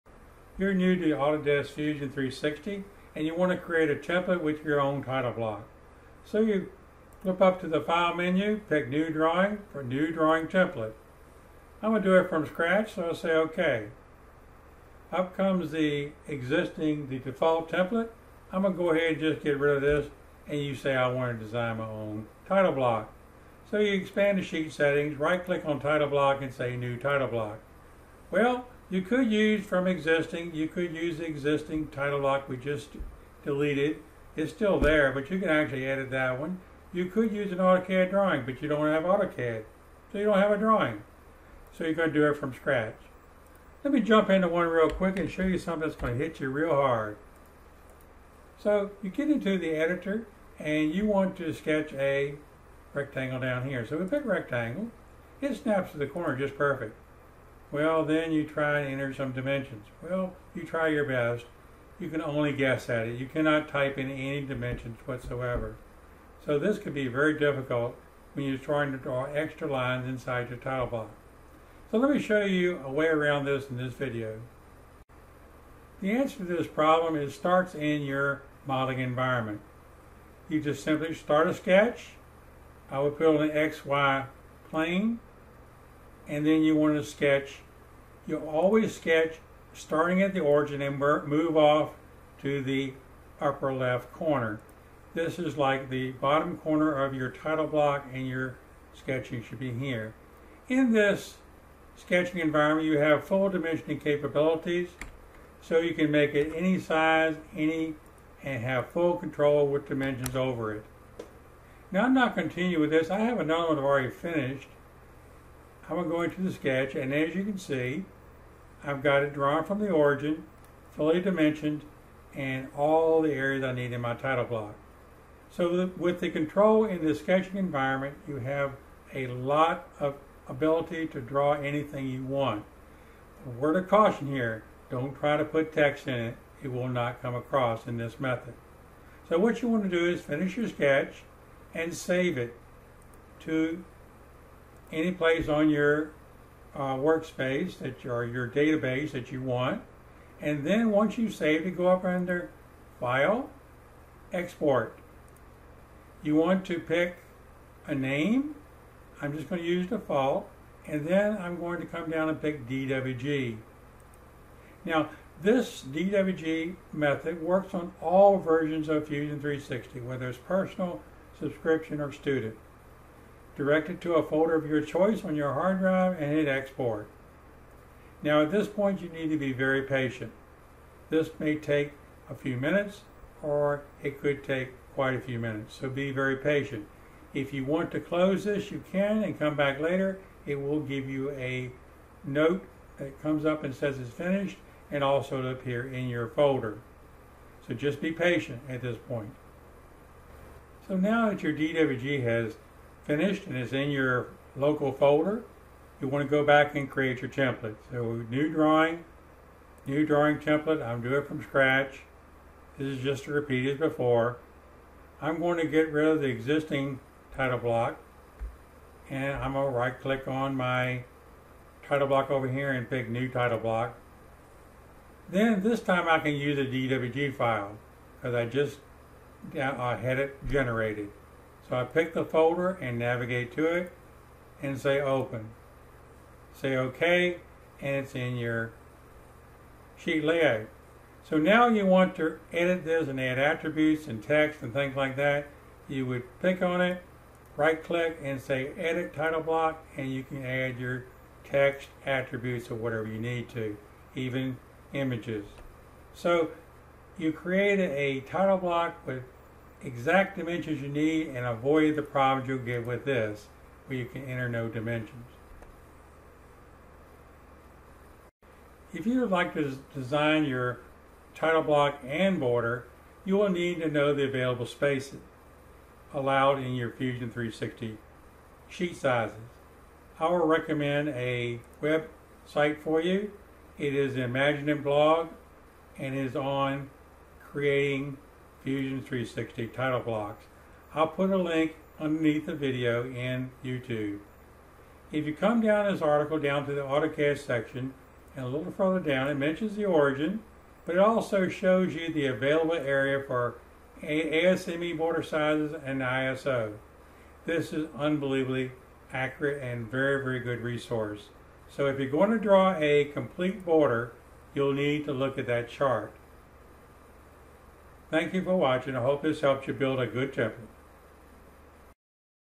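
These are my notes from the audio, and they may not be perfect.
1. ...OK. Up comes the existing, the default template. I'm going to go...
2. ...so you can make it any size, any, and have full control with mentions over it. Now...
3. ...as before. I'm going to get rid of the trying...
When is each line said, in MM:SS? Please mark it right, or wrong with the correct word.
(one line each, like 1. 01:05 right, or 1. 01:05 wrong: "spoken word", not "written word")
1. 00:13 right
2. 01:45 wrong: "dimensions", not "mentions"
3. 03:33 wrong: "existing", not "trying".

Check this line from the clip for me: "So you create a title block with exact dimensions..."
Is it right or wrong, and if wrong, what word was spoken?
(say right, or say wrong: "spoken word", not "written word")
right.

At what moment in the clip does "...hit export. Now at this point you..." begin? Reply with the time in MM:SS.
02:56.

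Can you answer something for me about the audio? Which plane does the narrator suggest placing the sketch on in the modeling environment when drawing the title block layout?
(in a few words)
XY plane.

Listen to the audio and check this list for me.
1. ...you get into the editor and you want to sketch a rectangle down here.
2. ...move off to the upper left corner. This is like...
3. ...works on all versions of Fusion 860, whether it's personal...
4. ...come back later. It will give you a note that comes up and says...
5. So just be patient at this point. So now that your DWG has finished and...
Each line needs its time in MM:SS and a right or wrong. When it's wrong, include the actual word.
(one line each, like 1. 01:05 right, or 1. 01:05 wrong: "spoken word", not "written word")
1. 00:49 right
2. 01:30 right
3. 02:47 wrong: "360", not "860"
4. 03:09 right
5. 03:17 right.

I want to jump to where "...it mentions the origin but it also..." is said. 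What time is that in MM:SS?
04:59.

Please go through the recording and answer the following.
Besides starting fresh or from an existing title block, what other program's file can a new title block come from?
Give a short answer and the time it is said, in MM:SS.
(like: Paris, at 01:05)
AutoCAD drawing, at 00:37.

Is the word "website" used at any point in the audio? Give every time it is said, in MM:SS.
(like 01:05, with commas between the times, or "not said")
04:41.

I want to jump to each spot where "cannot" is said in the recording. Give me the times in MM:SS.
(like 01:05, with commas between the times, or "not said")
01:03.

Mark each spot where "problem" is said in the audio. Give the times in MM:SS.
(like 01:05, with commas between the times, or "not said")
01:16, 04:22.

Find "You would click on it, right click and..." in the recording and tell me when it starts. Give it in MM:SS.
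04:05.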